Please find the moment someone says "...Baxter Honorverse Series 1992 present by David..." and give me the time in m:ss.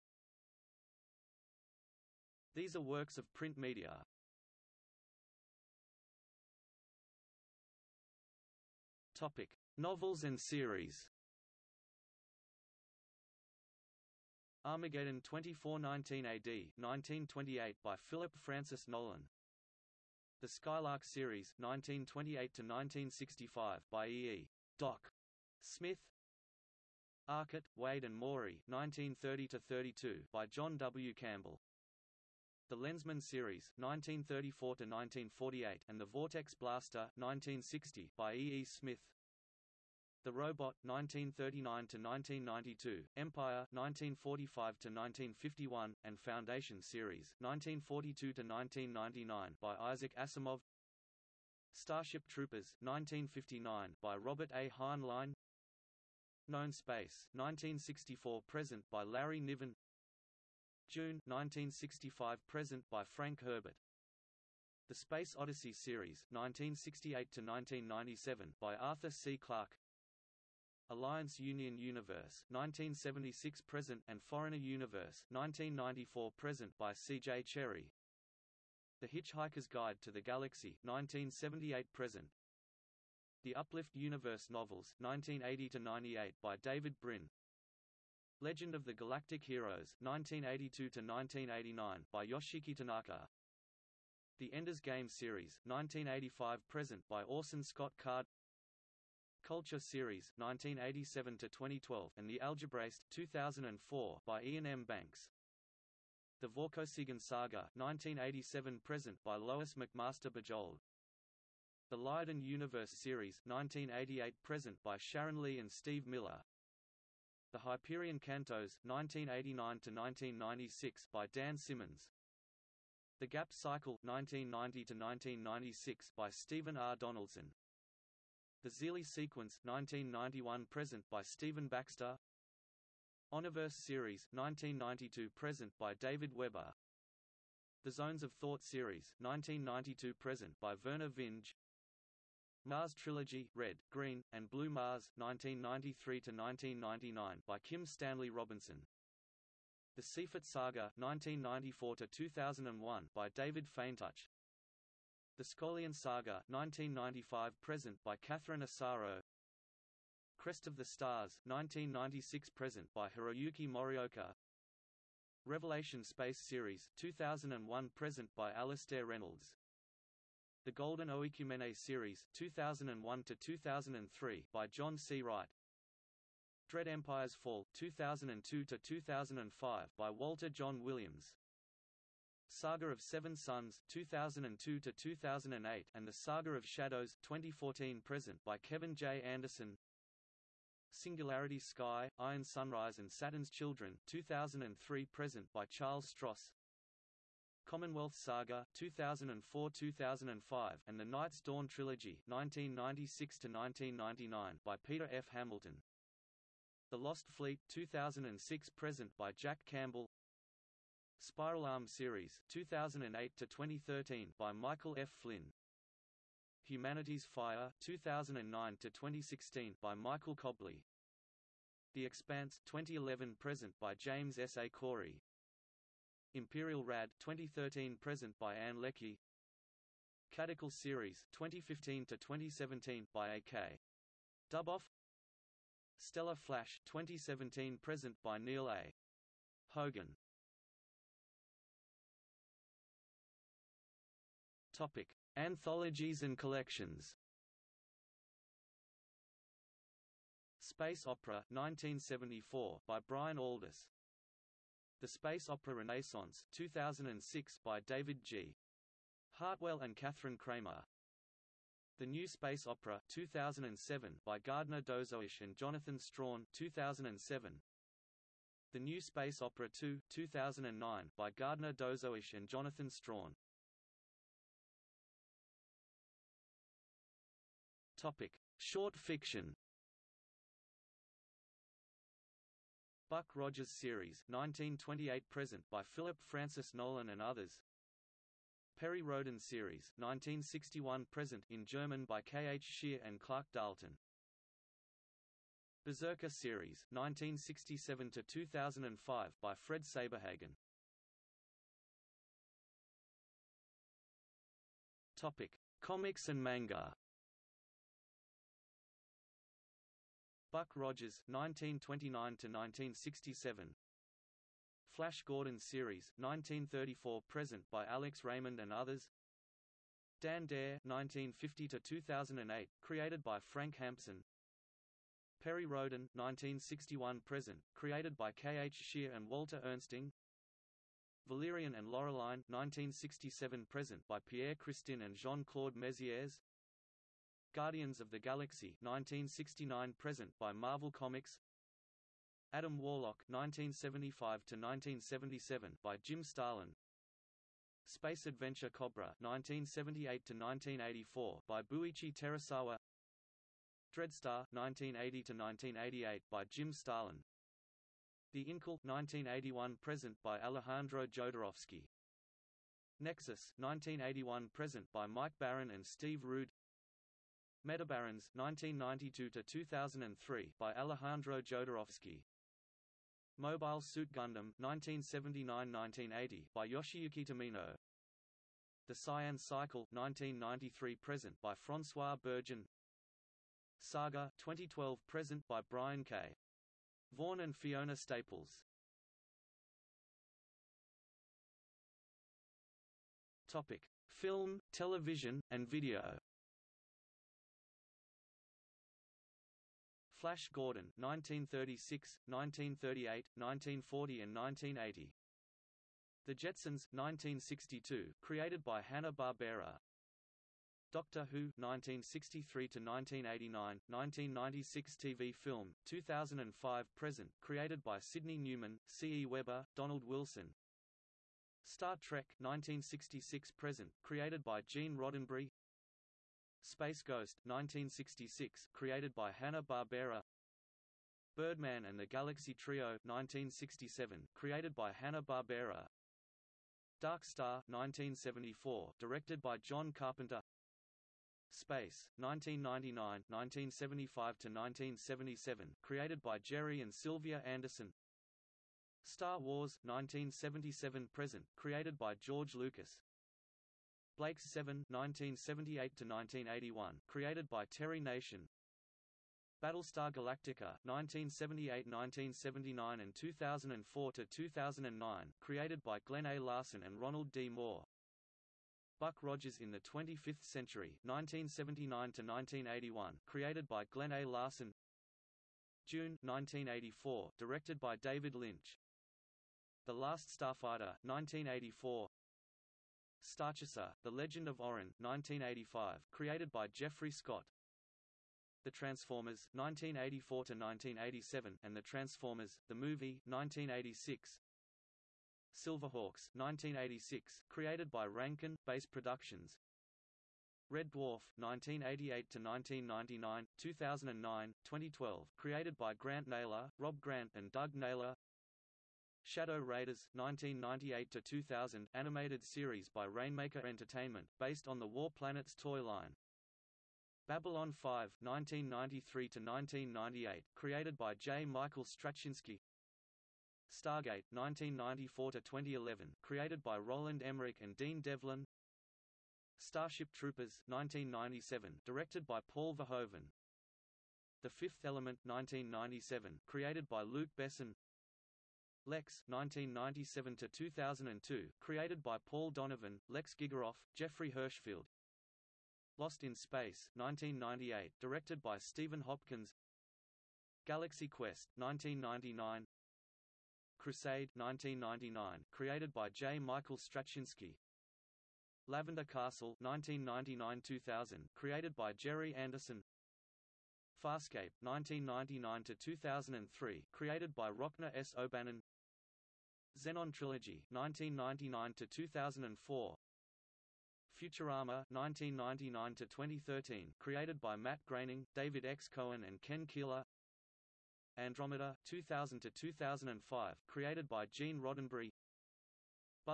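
2:11.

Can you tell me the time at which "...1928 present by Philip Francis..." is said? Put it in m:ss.
4:44.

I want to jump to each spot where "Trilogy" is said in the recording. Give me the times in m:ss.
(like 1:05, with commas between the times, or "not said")
2:22, 3:21, 9:30.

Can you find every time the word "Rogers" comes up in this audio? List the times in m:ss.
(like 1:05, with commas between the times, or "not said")
4:43, 5:10, 7:49.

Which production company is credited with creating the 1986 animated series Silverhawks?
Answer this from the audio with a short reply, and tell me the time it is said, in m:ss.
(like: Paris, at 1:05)
Rankin Base Productions, at 8:18.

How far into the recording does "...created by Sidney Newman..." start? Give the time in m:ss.
6:57.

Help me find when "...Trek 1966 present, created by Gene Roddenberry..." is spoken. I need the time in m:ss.
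7:02.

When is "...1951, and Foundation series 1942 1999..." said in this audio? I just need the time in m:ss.
0:44.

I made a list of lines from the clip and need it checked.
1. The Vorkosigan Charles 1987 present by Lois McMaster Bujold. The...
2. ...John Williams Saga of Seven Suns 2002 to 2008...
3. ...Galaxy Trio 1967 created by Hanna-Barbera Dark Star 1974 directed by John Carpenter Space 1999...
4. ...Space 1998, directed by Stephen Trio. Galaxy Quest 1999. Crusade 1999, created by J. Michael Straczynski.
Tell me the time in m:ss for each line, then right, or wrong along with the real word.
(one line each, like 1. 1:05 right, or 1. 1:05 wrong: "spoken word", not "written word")
1. 1:46 wrong: "Saga", not "Charles"
2. 3:00 right
3. 7:12 right
4. 9:06 wrong: "Hopkins", not "Trio".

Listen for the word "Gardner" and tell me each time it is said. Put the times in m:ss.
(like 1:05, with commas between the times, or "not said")
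4:24, 4:31.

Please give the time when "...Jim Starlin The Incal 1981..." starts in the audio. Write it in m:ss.
5:56.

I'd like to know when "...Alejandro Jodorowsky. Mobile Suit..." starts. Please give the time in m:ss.
6:10.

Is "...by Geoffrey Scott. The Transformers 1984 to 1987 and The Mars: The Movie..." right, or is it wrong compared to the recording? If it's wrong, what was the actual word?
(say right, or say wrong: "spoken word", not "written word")
wrong: "Transformers", not "Mars".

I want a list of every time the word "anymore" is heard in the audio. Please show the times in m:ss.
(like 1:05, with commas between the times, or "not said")
not said.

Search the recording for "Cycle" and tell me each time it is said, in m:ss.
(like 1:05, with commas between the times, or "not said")
2:03, 6:19.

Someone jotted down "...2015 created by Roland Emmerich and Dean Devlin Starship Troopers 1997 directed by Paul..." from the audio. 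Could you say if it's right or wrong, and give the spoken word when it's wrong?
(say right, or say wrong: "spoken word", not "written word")
wrong: "2011", not "2015".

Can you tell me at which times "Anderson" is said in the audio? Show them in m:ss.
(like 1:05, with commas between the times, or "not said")
3:09, 7:27, 9:22.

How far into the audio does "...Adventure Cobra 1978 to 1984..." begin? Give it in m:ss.
5:48.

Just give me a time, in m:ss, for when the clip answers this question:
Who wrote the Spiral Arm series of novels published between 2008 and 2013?
3:34.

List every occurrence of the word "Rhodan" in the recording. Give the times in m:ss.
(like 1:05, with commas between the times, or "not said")
4:49, 5:25.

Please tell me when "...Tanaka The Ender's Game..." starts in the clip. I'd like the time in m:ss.
1:32.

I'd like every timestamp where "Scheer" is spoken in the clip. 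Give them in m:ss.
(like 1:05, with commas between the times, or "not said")
4:52, 5:28.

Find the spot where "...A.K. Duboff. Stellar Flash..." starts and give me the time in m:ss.
3:53.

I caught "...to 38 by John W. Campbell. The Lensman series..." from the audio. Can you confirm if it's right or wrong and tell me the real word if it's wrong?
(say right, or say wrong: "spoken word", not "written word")
wrong: "32", not "38".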